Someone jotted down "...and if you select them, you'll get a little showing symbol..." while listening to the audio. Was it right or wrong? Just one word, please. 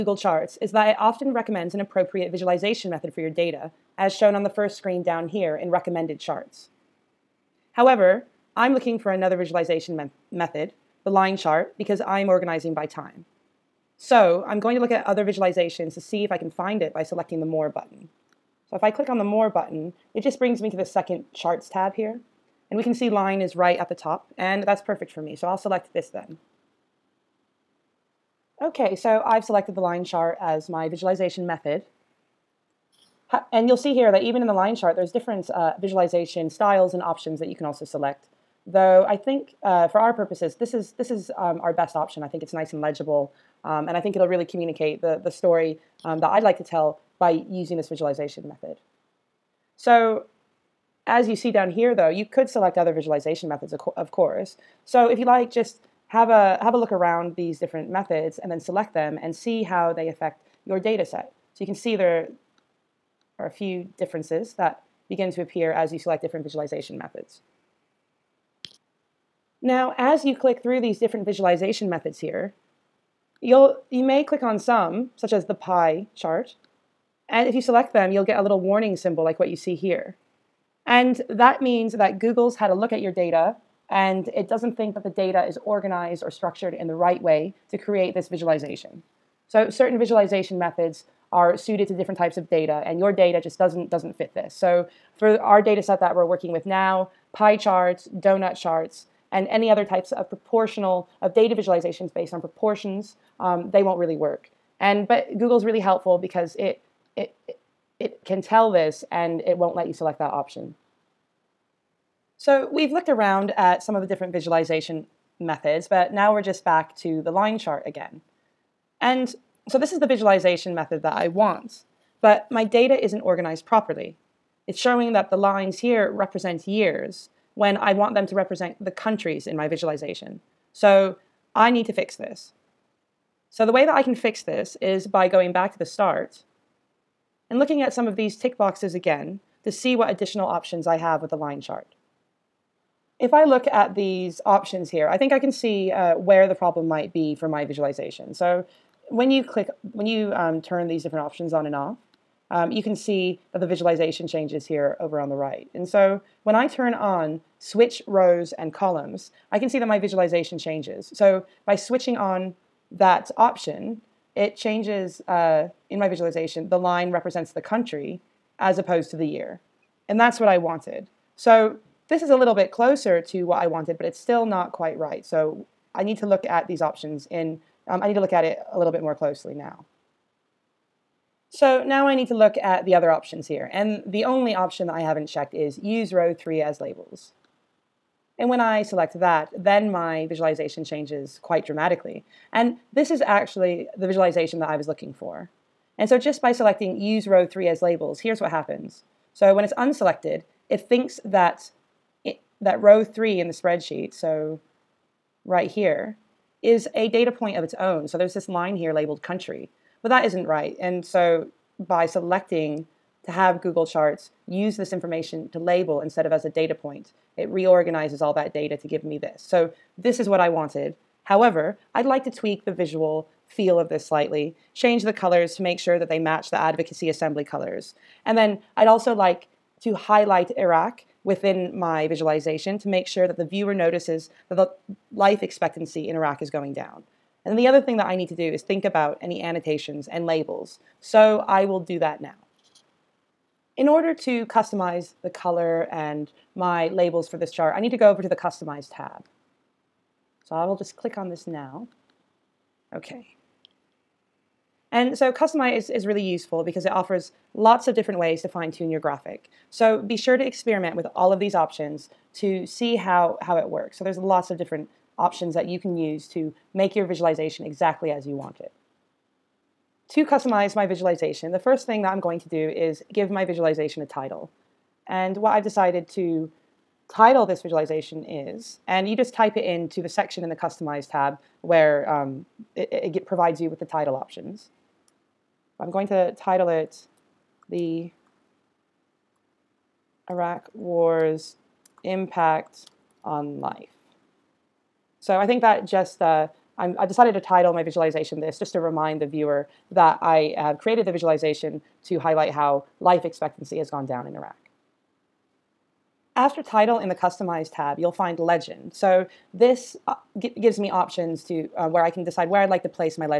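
wrong.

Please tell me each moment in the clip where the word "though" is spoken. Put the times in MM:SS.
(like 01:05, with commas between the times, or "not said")
00:38, 00:51.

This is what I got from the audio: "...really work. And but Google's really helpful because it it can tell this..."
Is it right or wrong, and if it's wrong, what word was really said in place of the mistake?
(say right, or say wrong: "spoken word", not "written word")
right.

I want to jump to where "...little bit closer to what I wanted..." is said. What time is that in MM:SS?
02:52.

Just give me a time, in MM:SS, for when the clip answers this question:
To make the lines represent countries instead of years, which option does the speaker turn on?
02:37.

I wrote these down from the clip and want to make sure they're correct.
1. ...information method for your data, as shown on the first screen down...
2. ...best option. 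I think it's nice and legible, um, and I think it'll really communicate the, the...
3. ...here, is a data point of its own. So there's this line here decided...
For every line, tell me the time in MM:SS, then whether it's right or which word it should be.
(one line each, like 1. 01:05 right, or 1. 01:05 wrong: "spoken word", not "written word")
1. 00:02 wrong: "visualization", not "information"
2. 00:41 right
3. 03:25 wrong: "labeled", not "decided".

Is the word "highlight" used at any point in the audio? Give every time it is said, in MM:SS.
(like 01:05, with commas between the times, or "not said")
03:49, 05:02.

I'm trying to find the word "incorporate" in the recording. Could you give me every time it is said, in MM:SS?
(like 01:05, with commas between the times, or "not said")
not said.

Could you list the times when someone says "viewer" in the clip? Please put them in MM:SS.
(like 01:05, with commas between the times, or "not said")
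03:53, 04:59.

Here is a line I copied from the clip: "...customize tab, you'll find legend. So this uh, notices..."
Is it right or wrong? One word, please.
wrong.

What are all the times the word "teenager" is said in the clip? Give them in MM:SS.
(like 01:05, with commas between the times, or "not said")
not said.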